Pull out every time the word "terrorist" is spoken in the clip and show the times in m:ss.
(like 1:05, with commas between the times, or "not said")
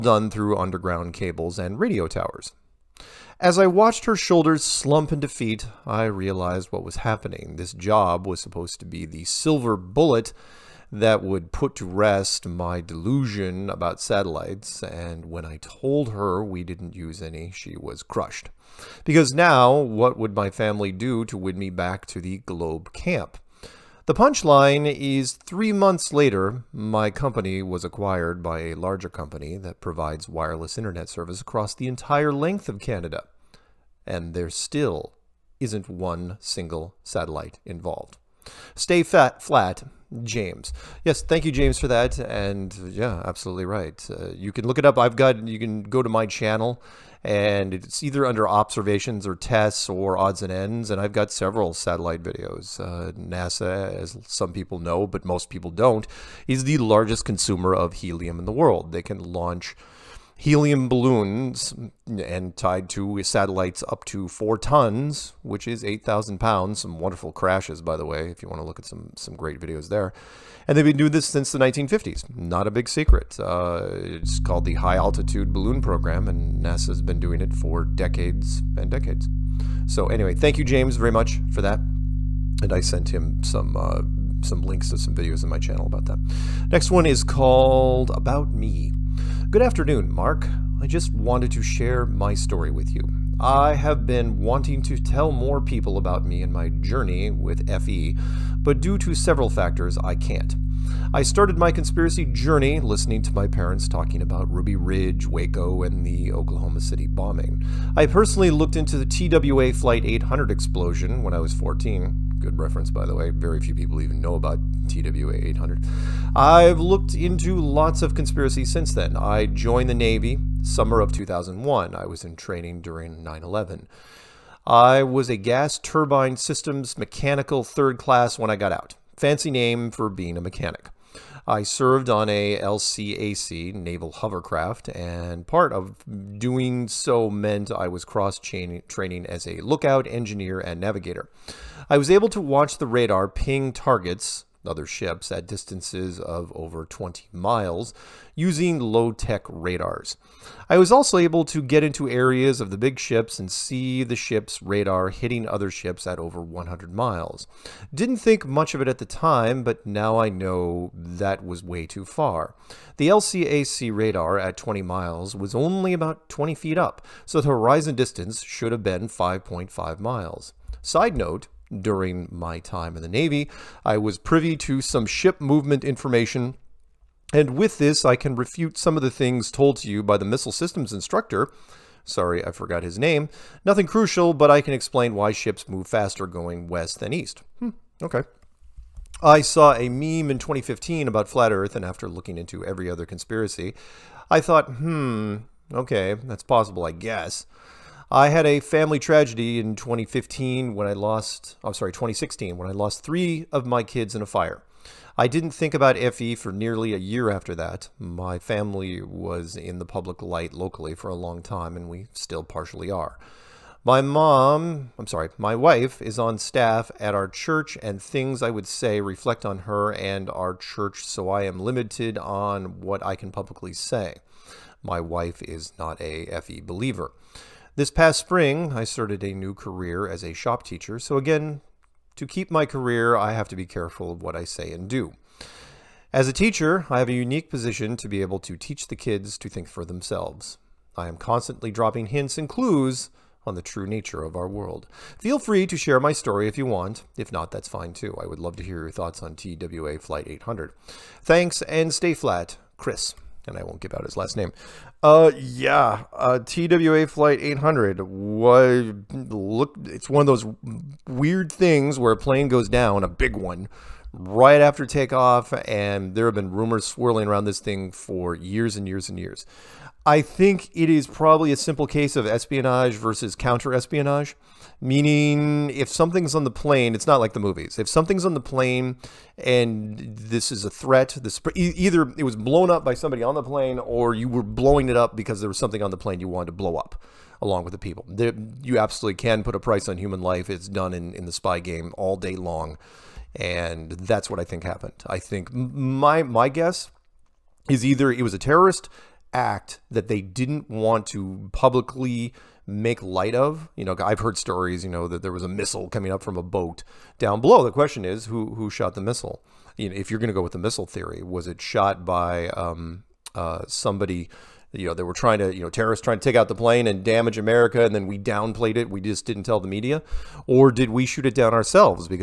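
4:58, 5:15.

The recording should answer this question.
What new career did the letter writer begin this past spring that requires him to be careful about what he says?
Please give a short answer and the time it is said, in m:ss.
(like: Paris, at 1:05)
Shop teacher, at 3:50.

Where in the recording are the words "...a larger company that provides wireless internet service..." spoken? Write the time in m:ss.
0:28.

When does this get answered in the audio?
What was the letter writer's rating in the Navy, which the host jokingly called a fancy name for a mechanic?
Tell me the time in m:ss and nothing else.
2:05.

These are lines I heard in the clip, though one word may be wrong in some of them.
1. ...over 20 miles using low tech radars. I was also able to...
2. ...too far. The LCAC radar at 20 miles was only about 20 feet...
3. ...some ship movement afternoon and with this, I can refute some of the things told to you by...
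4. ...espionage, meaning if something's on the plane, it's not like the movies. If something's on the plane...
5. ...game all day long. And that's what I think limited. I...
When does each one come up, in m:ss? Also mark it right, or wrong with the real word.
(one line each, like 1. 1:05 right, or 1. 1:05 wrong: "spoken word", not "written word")
1. 2:26 right
2. 2:41 right
3. 2:54 wrong: "information", not "afternoon"
4. 4:33 right
5. 4:51 wrong: "happened", not "limited".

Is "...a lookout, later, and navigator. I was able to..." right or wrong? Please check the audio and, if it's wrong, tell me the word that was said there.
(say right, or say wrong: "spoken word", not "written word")
wrong: "engineer", not "later".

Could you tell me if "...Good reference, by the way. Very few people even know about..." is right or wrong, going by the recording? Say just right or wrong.
right.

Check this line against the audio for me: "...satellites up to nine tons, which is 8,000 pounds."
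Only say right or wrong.
wrong.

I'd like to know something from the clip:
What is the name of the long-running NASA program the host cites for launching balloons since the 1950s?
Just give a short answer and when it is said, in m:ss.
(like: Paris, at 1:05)
High Altitude Balloon Program, at 1:14.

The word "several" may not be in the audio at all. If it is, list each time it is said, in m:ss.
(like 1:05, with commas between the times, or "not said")
0:51, 1:39.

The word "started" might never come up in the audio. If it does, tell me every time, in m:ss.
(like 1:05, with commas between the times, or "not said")
1:41, 3:48.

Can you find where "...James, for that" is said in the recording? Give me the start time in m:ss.
0:41.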